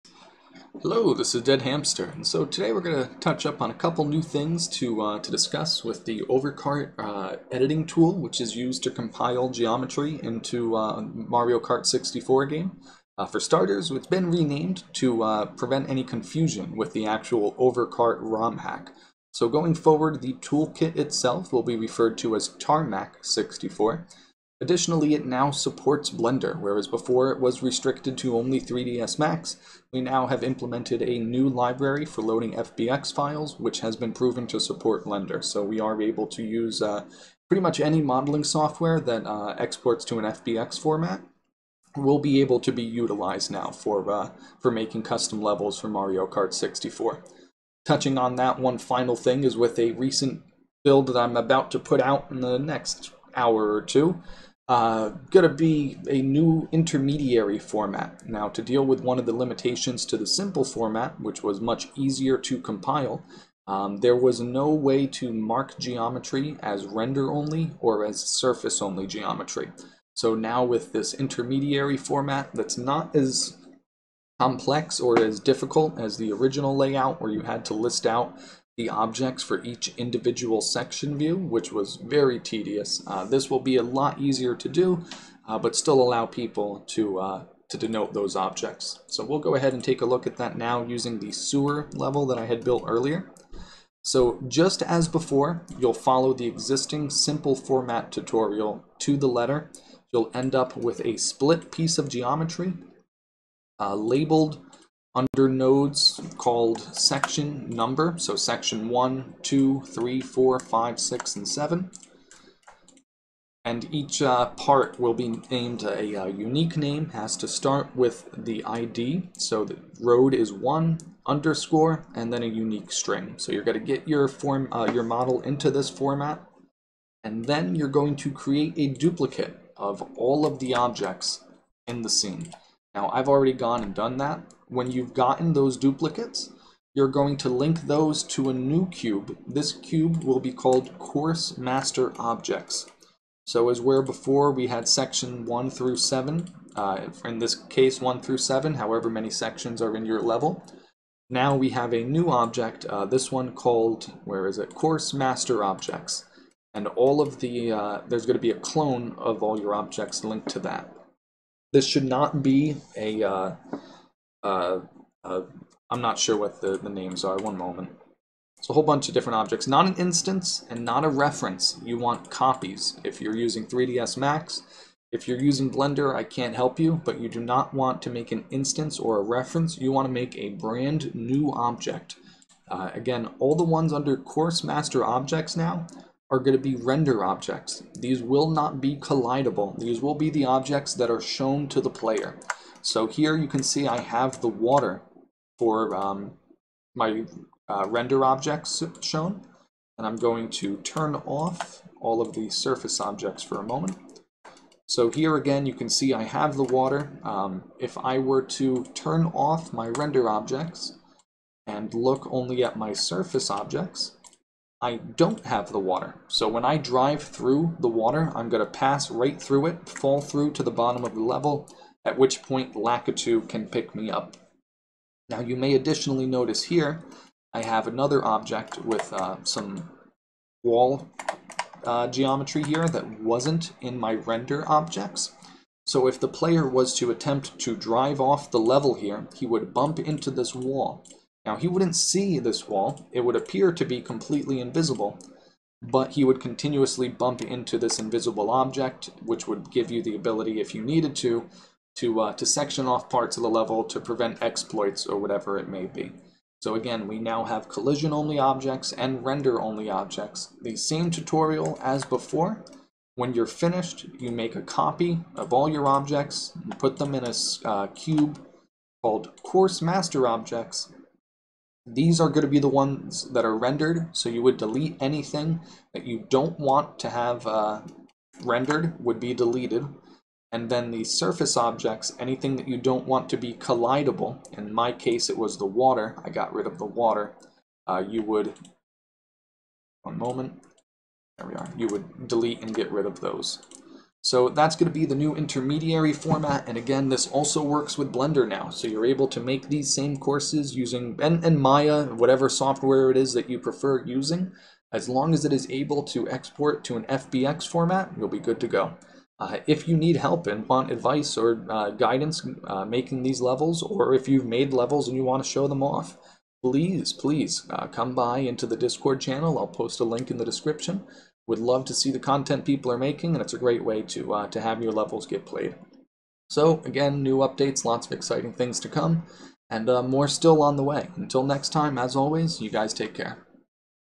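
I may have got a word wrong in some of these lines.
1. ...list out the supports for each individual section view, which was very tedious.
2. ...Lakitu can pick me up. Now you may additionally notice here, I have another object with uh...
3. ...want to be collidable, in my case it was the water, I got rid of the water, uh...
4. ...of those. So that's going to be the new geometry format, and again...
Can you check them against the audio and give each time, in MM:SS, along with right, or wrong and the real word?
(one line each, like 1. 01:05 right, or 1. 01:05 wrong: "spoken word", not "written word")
1. 01:17 wrong: "objects", not "supports"
2. 03:42 right
3. 04:43 right
4. 04:53 wrong: "intermediary", not "geometry".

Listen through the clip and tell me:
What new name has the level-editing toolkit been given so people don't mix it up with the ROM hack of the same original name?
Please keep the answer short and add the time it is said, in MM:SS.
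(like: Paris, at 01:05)
Tarmac 64, at 00:22.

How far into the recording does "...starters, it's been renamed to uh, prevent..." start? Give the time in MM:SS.
00:13.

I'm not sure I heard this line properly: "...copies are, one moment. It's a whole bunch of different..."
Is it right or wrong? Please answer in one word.
wrong.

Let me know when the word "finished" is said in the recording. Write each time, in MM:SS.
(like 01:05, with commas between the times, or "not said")
04:23.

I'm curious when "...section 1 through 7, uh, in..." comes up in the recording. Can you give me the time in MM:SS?
02:24.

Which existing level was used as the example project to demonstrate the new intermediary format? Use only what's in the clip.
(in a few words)
The sewer level.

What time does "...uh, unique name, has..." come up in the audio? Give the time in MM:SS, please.
01:56.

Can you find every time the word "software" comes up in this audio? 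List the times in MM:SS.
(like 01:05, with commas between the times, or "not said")
00:38, 05:02.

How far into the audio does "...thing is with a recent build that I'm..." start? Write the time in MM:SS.
00:49.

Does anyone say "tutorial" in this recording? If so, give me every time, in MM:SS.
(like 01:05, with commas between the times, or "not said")
01:38, 04:21.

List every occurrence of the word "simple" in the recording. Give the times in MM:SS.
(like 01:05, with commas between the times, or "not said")
01:00, 01:37.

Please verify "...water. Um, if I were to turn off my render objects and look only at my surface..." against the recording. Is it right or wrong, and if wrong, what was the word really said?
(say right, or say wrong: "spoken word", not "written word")
right.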